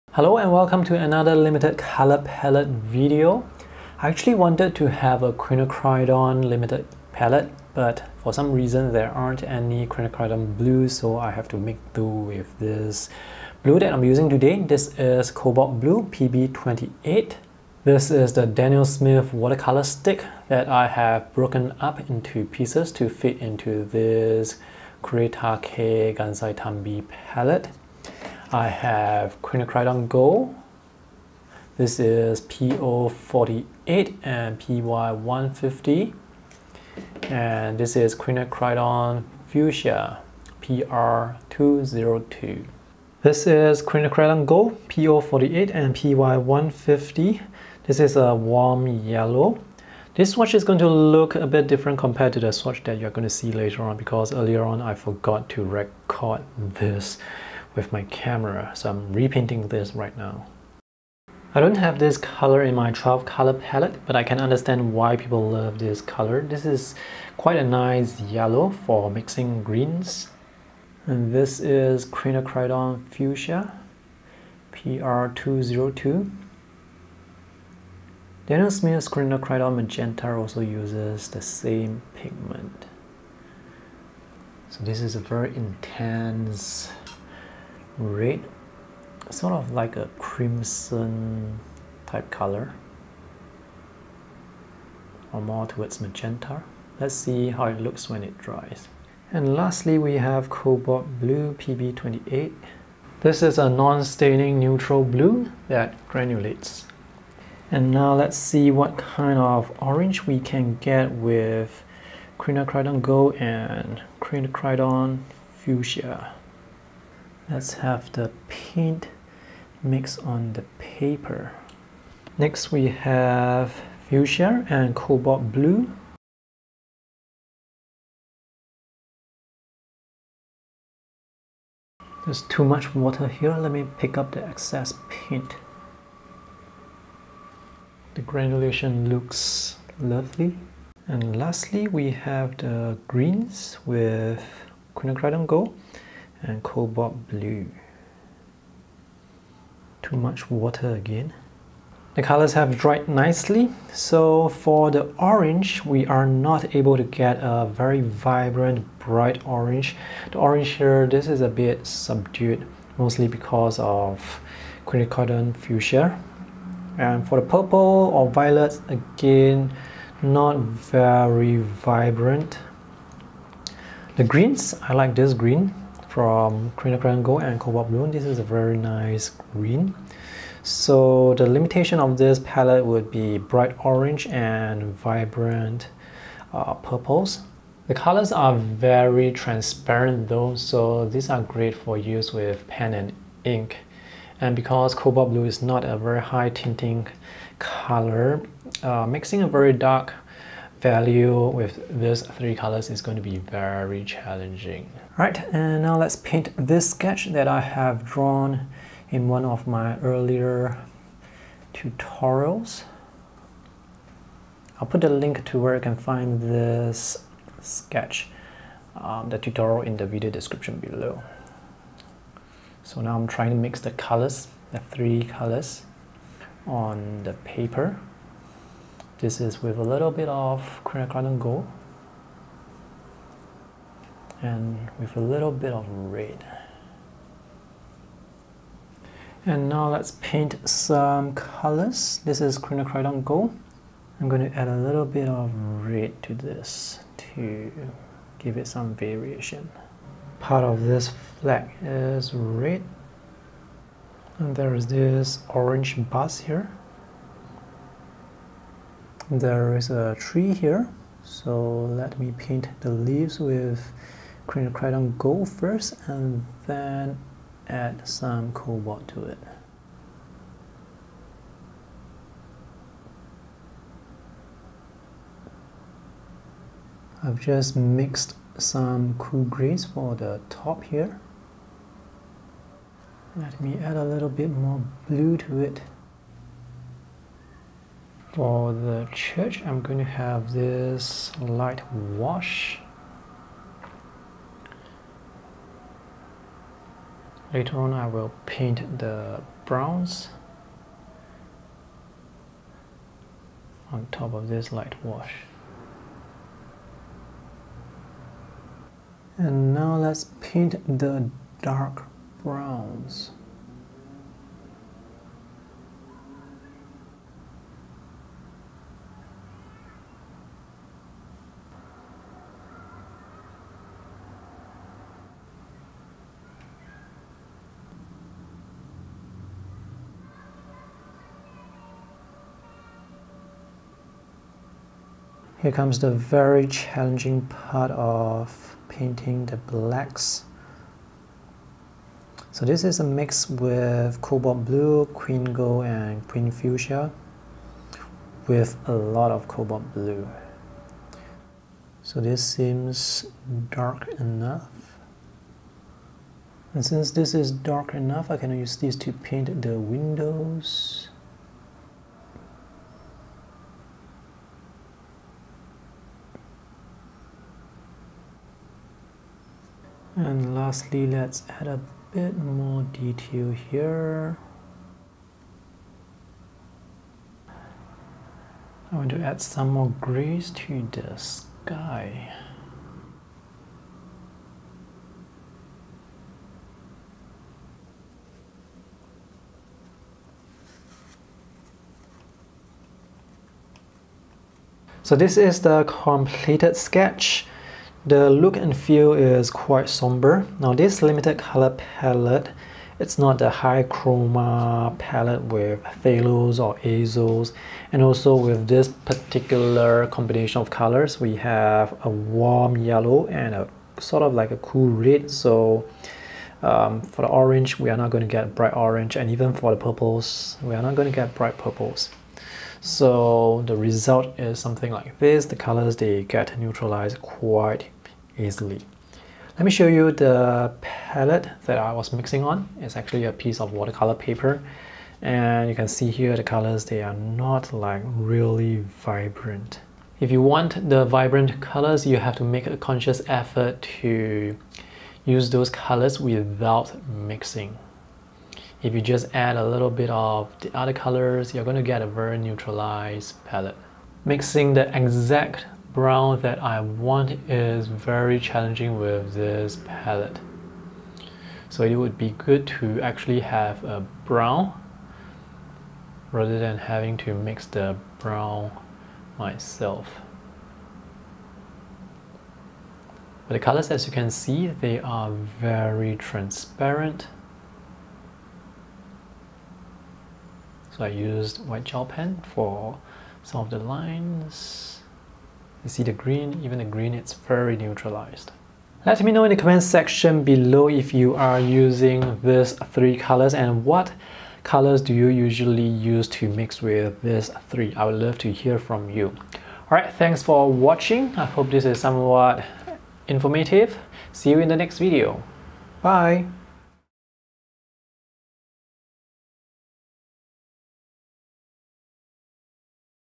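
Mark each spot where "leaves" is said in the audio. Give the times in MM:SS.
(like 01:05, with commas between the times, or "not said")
04:22.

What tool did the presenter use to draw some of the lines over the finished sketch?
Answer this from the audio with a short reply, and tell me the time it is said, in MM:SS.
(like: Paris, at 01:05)
white gel pen, at 08:01.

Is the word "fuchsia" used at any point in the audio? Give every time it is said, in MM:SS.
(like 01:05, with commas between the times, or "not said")
00:39, 01:13, 01:55, 02:04, 02:45, 05:46.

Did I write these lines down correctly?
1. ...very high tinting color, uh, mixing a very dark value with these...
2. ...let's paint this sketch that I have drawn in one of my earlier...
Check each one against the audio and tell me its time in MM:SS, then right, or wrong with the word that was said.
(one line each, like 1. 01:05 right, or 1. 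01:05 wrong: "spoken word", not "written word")
1. 03:15 right
2. 03:25 right.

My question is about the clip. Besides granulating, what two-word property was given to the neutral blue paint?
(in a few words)
non-staining.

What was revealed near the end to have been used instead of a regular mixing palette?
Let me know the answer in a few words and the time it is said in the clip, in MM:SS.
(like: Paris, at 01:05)
a piece of watercolor paper, at 07:13.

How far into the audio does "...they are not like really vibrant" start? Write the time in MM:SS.
07:16.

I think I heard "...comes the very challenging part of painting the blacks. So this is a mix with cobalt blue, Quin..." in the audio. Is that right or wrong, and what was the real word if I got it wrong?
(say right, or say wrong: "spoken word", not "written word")
right.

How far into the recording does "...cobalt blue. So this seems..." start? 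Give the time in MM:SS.
05:49.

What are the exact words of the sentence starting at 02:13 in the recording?
Let me pick up the excess paint.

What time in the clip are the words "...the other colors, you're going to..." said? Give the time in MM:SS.
07:30.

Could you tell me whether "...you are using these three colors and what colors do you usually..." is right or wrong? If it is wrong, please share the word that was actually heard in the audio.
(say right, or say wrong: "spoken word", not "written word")
right.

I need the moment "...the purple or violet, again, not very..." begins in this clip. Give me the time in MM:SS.
02:47.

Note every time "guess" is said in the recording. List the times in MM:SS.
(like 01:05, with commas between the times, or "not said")
not said.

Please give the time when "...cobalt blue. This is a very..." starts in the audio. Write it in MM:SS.
02:57.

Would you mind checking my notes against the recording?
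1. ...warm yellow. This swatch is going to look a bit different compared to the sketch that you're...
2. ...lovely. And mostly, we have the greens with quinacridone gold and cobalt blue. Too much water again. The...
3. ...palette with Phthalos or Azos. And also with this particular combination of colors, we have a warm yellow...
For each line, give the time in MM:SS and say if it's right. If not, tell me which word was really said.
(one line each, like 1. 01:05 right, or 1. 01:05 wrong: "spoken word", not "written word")
1. 00:48 wrong: "swatch", not "sketch"
2. 02:19 wrong: "lastly", not "mostly"
3. 06:44 right.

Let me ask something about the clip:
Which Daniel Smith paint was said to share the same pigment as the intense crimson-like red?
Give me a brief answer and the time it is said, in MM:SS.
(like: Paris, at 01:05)
Quinacridone Magenta, at 01:19.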